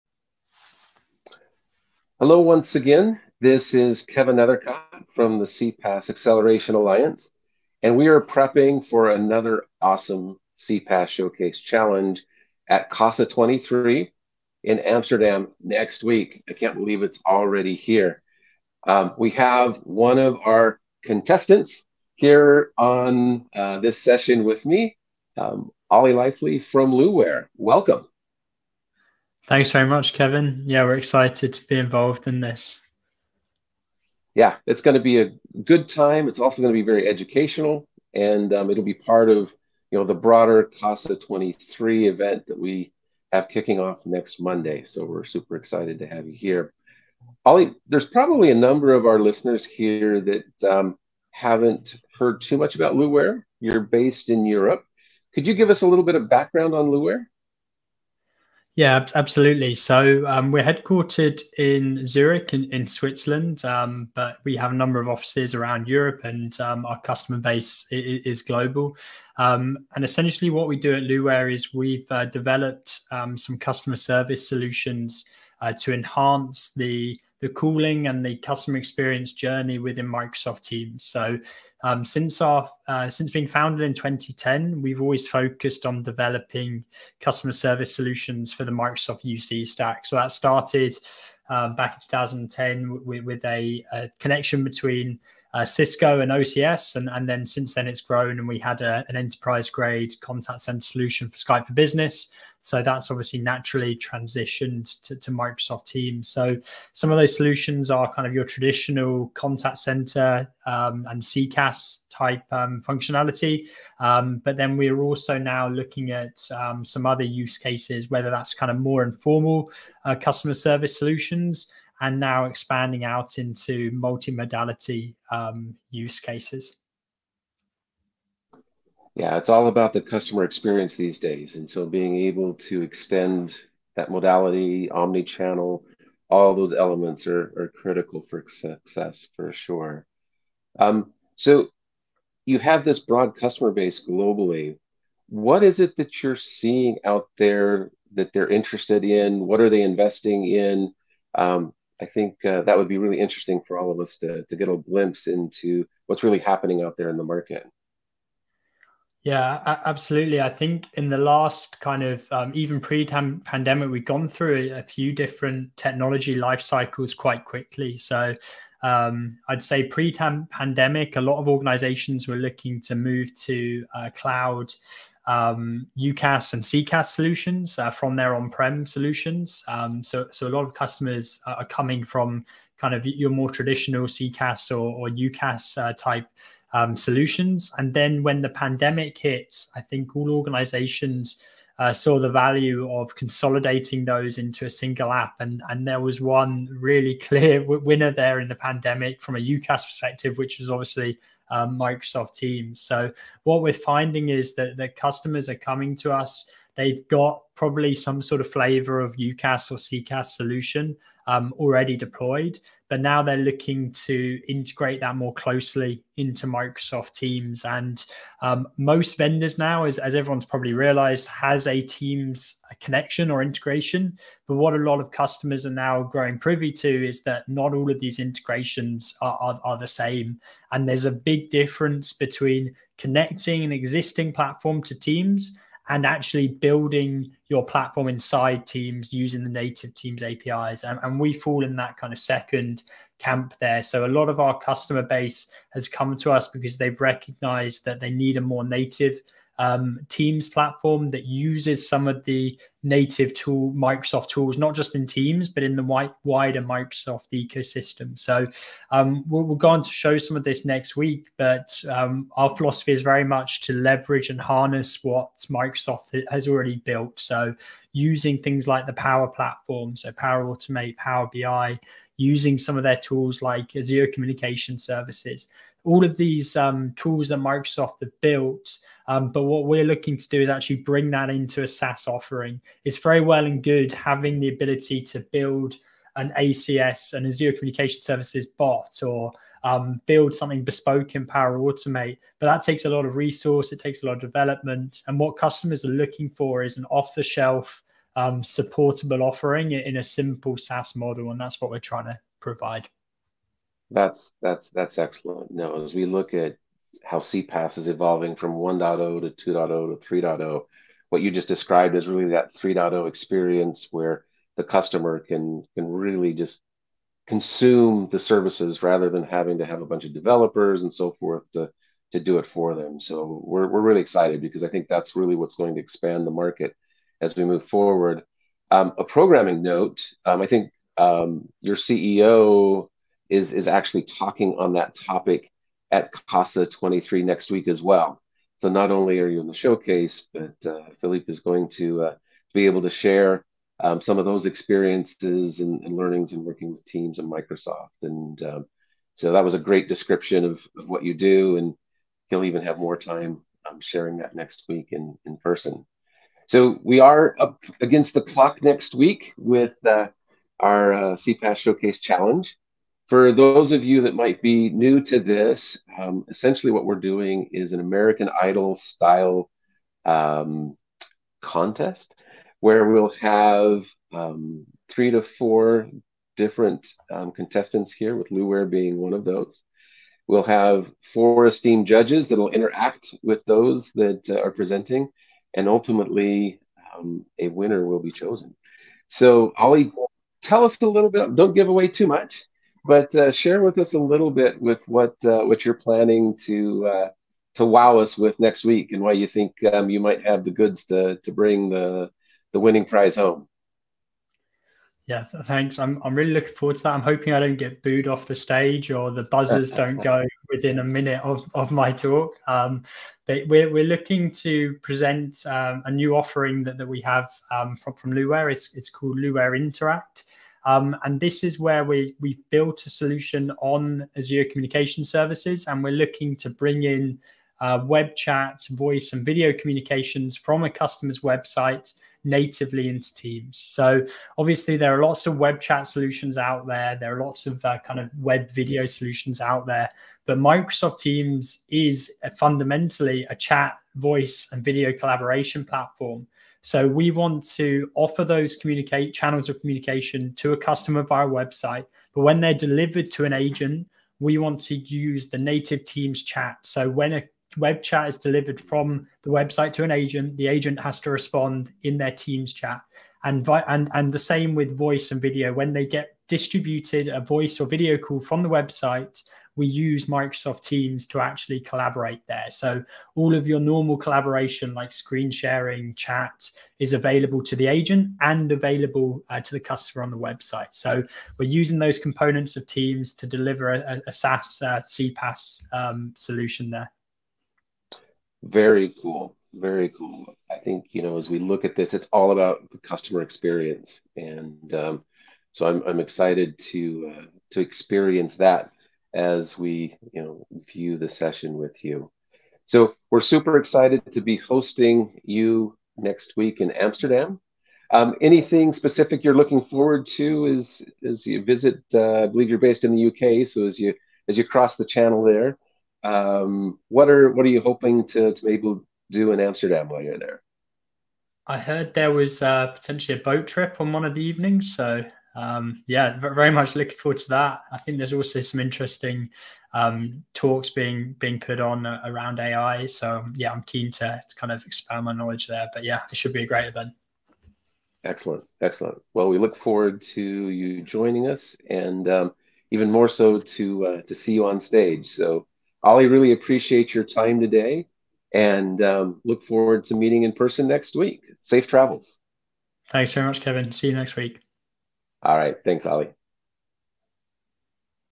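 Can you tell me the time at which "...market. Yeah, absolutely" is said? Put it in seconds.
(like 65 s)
157 s.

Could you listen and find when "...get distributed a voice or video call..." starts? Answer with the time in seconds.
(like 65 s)
465 s.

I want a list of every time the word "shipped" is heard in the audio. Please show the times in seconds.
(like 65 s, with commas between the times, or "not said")
not said.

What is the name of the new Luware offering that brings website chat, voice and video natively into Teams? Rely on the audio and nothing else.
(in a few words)
Luware Interact.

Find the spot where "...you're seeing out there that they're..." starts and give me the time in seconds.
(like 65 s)
146 s.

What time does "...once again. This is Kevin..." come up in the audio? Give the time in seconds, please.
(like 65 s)
2 s.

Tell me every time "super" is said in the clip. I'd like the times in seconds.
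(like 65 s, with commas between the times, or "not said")
45 s, 503 s.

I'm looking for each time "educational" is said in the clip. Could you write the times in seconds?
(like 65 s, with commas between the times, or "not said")
37 s.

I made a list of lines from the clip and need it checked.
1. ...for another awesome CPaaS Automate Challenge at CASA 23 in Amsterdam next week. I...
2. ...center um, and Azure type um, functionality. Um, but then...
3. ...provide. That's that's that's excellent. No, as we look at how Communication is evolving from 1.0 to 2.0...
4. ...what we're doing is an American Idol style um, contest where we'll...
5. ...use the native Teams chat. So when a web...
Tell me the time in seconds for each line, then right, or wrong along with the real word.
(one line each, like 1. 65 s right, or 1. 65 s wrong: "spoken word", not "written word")
1. 8 s wrong: "Showcase", not "Automate"
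2. 109 s wrong: "CCaaS", not "Azure"
3. 302 s wrong: "CPaaS", not "Communication"
4. 366 s right
5. 454 s right.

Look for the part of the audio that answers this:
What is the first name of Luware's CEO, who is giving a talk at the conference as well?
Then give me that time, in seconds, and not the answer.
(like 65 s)
340 s.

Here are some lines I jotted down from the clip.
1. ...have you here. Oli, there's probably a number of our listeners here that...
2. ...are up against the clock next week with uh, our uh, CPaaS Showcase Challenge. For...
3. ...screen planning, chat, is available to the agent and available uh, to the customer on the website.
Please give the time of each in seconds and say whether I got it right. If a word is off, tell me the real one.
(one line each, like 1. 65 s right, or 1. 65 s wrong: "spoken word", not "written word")
1. 46 s right
2. 356 s right
3. 474 s wrong: "sharing", not "planning".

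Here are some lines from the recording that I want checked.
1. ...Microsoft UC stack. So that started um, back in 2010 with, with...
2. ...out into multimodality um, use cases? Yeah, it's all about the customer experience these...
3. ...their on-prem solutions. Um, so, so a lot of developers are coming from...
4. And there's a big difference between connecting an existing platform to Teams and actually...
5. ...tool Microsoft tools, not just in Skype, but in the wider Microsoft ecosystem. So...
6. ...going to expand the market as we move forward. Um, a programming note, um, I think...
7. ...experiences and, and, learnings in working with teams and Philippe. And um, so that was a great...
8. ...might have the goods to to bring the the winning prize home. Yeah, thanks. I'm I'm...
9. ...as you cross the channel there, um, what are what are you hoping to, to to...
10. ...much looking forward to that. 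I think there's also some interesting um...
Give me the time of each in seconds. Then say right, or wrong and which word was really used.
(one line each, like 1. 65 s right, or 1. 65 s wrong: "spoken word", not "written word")
1. 88 s right
2. 123 s right
3. 178 s wrong: "customers", not "developers"
4. 230 s right
5. 253 s wrong: "Teams", not "Skype"
6. 325 s right
7. 344 s wrong: "Microsoft", not "Philippe"
8. 399 s right
9. 514 s right
10. 526 s right.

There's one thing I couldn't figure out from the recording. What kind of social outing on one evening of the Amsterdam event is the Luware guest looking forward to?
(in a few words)
A boat trip.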